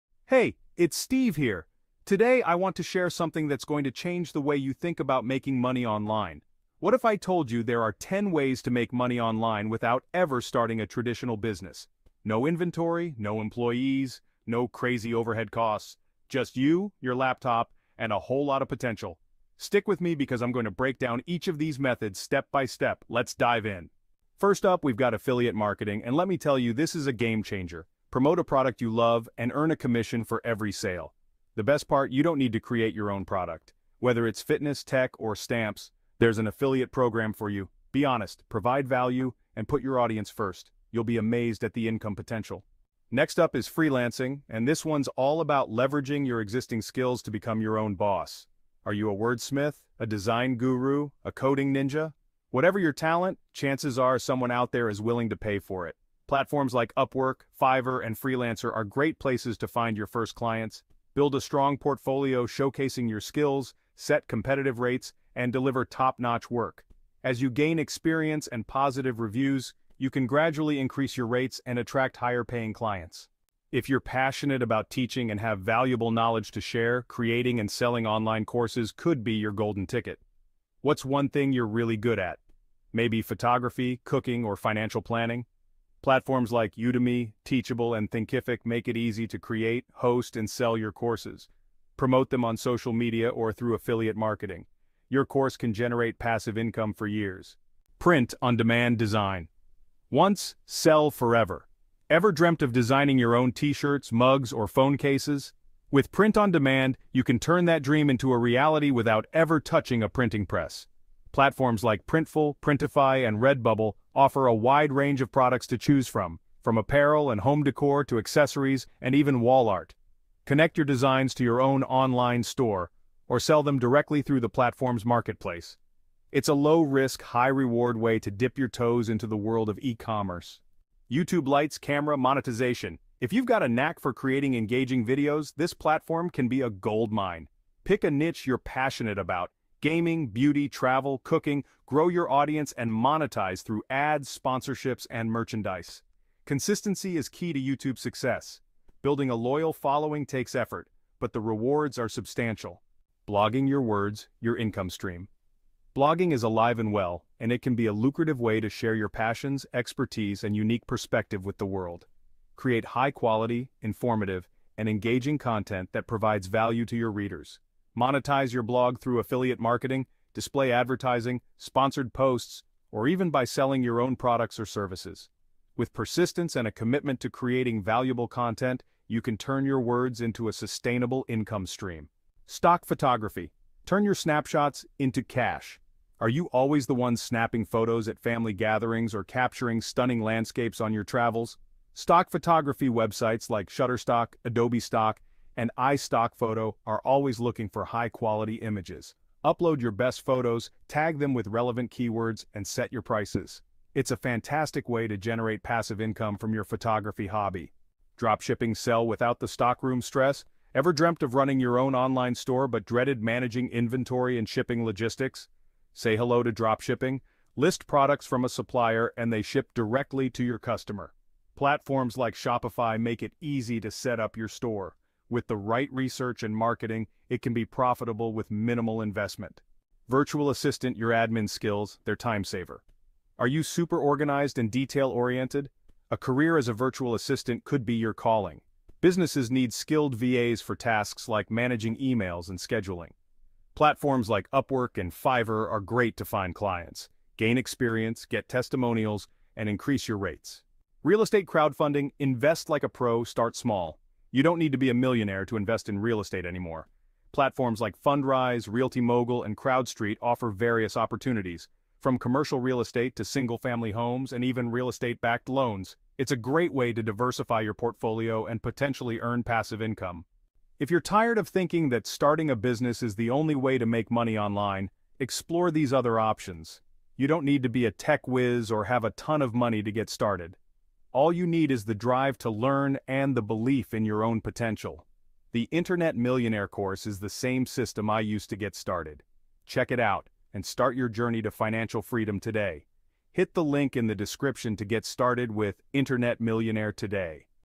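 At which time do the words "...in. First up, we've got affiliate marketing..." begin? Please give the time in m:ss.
0:23.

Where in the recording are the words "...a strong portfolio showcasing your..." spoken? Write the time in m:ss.
1:01.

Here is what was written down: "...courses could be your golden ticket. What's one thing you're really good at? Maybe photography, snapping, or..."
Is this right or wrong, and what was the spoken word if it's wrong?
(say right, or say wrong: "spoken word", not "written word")
wrong: "cooking", not "snapping".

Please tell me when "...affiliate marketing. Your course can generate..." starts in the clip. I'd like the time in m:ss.
1:33.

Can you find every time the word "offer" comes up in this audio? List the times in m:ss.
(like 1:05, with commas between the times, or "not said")
1:54, 4:20.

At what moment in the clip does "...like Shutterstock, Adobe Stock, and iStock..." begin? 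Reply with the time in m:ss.
3:13.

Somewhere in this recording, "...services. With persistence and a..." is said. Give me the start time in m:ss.
2:54.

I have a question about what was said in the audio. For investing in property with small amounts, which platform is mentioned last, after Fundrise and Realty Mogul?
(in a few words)
CrowdStreet.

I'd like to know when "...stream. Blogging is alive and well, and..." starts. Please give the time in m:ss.
2:34.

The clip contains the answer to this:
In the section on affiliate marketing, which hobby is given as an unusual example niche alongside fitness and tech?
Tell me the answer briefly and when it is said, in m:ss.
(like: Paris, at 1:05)
Stamps, at 0:35.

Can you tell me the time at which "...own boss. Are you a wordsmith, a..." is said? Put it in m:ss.
0:47.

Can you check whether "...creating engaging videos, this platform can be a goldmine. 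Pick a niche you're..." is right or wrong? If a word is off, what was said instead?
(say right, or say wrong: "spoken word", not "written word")
right.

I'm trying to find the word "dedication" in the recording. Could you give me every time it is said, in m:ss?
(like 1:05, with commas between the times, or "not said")
not said.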